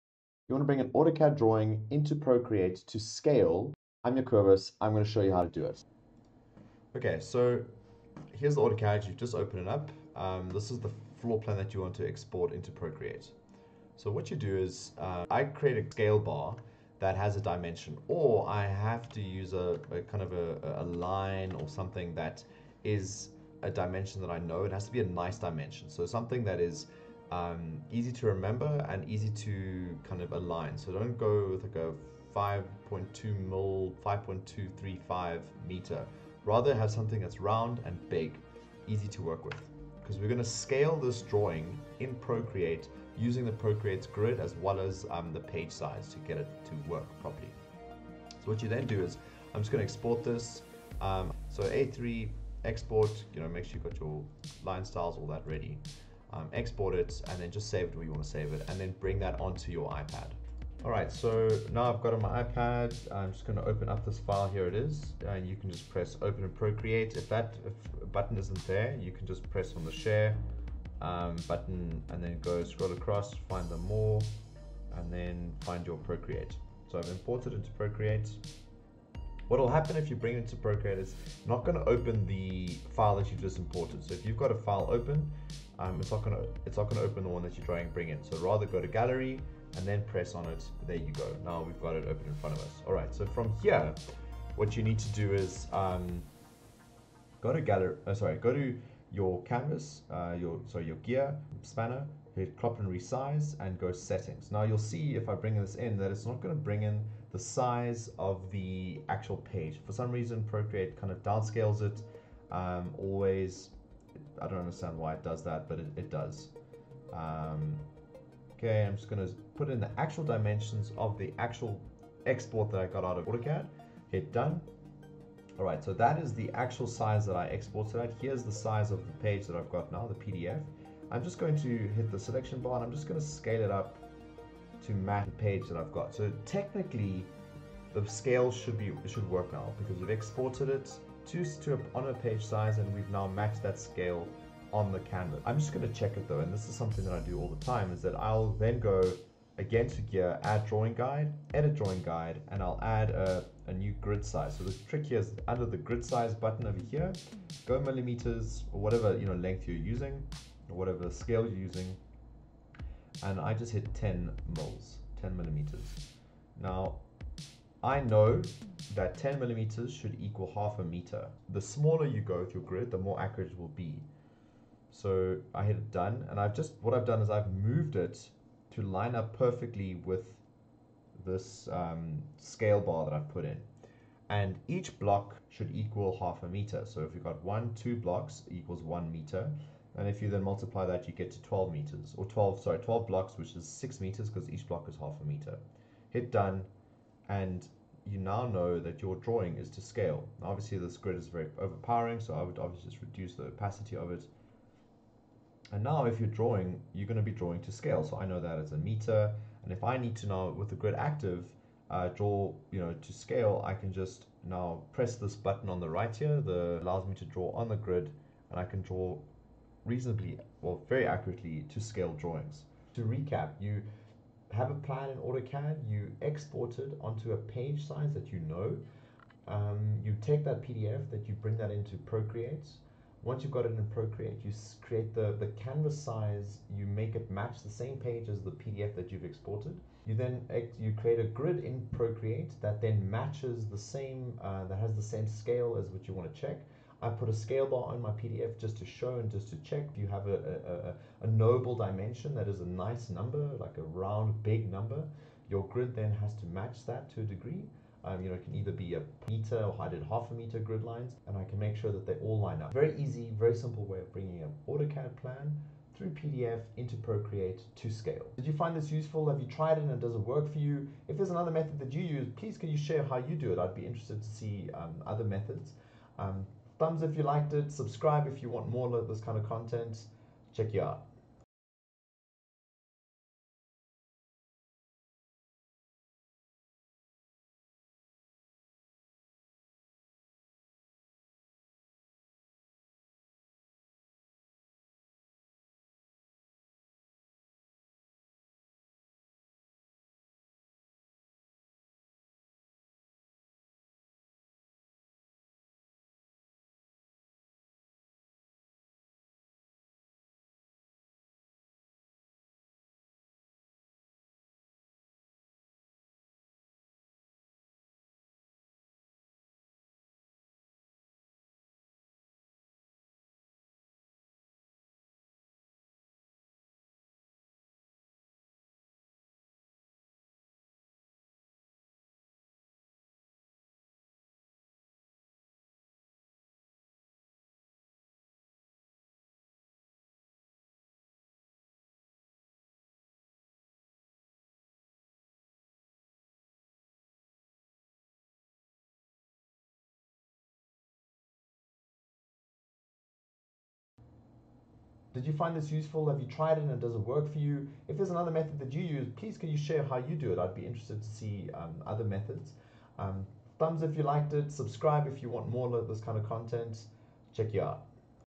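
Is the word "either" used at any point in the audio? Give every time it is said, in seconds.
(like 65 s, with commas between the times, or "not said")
258 s.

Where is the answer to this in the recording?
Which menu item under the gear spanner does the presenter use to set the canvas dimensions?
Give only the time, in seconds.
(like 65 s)
102 s.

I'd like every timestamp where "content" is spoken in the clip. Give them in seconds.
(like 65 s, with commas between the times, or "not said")
279 s, 366 s.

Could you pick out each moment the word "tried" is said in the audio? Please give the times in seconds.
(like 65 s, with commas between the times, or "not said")
269 s, 356 s.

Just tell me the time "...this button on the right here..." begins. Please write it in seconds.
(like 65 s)
215 s.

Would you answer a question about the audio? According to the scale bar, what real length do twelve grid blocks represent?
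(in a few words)
6 meters.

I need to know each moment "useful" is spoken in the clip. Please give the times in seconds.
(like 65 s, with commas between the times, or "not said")
268 s, 355 s.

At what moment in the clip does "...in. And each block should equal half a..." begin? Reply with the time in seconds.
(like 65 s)
183 s.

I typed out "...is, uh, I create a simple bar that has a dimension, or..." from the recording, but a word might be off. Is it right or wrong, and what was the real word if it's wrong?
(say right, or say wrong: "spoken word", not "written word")
wrong: "scale", not "simple".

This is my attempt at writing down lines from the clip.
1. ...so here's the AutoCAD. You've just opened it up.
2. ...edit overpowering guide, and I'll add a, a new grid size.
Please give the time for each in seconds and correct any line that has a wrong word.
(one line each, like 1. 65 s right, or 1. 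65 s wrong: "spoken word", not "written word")
1. 7 s right
2. 151 s wrong: "drawing", not "overpowering".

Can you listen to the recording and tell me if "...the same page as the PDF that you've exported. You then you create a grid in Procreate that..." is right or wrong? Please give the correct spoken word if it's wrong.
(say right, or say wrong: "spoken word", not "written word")
right.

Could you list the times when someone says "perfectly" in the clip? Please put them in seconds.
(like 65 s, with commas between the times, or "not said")
179 s.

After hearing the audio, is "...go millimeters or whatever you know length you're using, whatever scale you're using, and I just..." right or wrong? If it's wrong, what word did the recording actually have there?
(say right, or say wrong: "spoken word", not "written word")
right.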